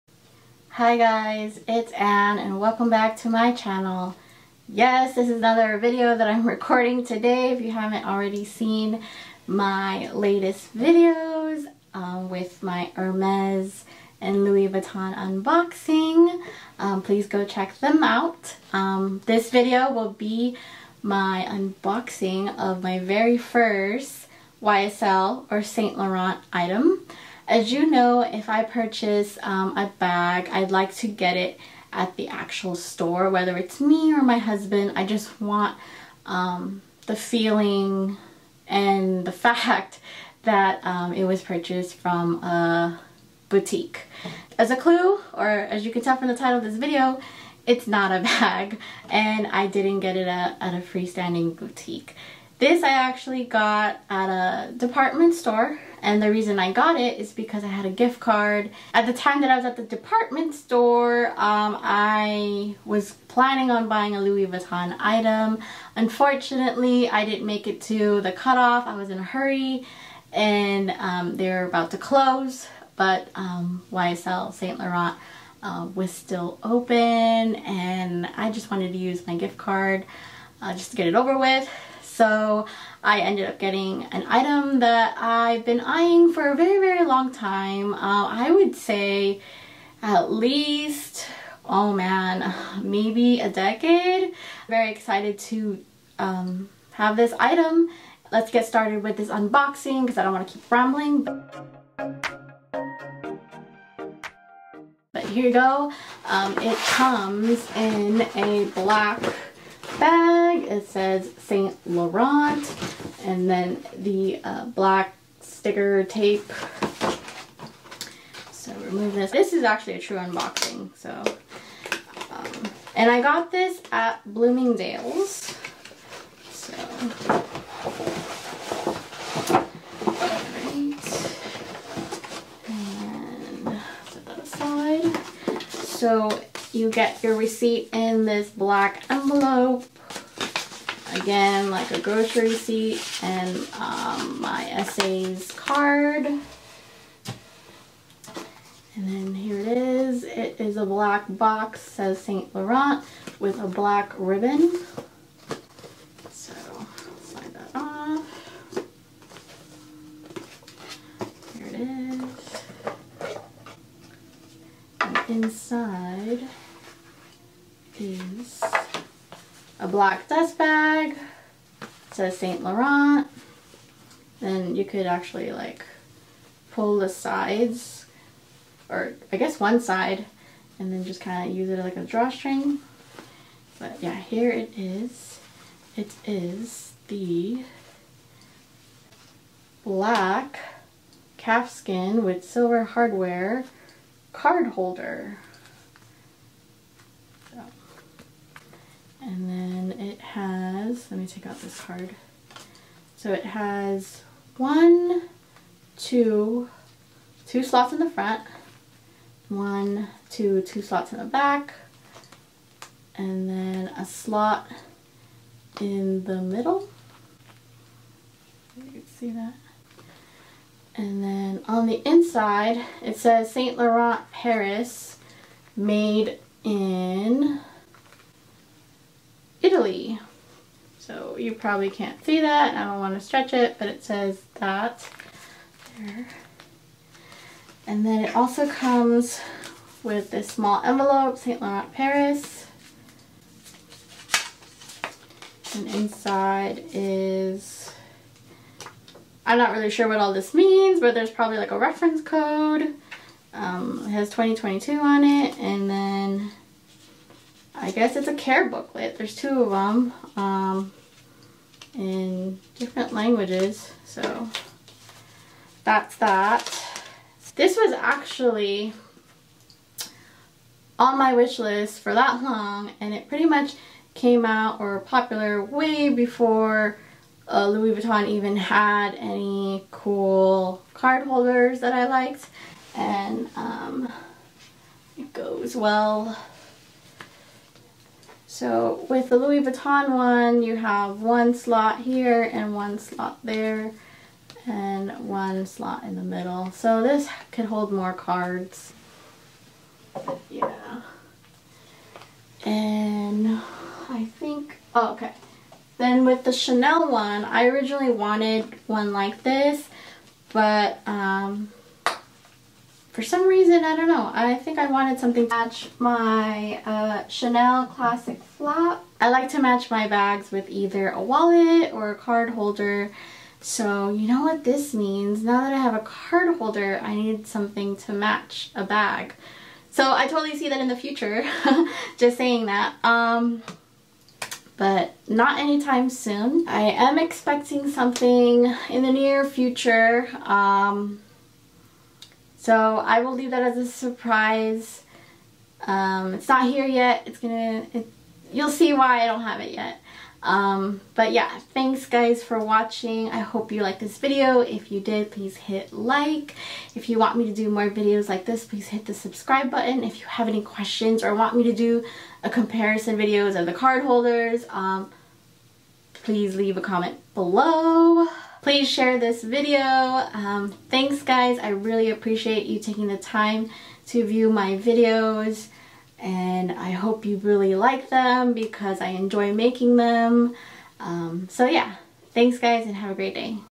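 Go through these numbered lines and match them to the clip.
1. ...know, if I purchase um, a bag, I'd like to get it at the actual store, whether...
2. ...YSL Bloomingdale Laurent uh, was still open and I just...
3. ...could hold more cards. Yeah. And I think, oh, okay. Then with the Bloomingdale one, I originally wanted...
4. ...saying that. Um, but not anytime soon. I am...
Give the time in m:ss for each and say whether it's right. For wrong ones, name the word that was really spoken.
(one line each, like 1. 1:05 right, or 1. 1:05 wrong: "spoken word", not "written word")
1. 0:27 right
2. 1:13 wrong: "Saint", not "Bloomingdale"
3. 4:57 wrong: "Chanel", not "Bloomingdale"
4. 5:32 right.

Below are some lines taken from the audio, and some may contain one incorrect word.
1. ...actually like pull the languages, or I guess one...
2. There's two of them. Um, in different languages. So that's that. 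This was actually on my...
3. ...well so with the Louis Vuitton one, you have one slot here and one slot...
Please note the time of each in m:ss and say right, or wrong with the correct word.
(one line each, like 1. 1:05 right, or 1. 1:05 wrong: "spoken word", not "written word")
1. 2:55 wrong: "sides", not "languages"
2. 4:19 right
3. 4:45 right.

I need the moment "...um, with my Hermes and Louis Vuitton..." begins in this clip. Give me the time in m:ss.
0:11.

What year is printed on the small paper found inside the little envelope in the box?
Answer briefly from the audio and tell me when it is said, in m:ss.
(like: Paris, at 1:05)
2022, at 4:14.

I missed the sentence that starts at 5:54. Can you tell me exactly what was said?
If you did, please hit like.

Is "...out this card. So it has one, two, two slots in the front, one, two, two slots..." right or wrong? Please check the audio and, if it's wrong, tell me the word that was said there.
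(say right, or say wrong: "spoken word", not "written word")
right.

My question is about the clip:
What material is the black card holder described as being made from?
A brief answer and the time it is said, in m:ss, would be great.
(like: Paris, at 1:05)
calfskin, at 3:11.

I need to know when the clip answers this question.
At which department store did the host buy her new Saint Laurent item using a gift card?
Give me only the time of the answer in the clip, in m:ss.
2:04.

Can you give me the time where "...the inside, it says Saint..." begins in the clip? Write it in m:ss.
3:41.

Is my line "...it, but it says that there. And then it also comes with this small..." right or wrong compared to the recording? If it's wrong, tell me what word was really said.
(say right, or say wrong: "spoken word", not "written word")
right.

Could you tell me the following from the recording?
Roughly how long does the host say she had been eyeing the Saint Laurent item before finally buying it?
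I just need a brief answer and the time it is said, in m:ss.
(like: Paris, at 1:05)
a decade, at 1:33.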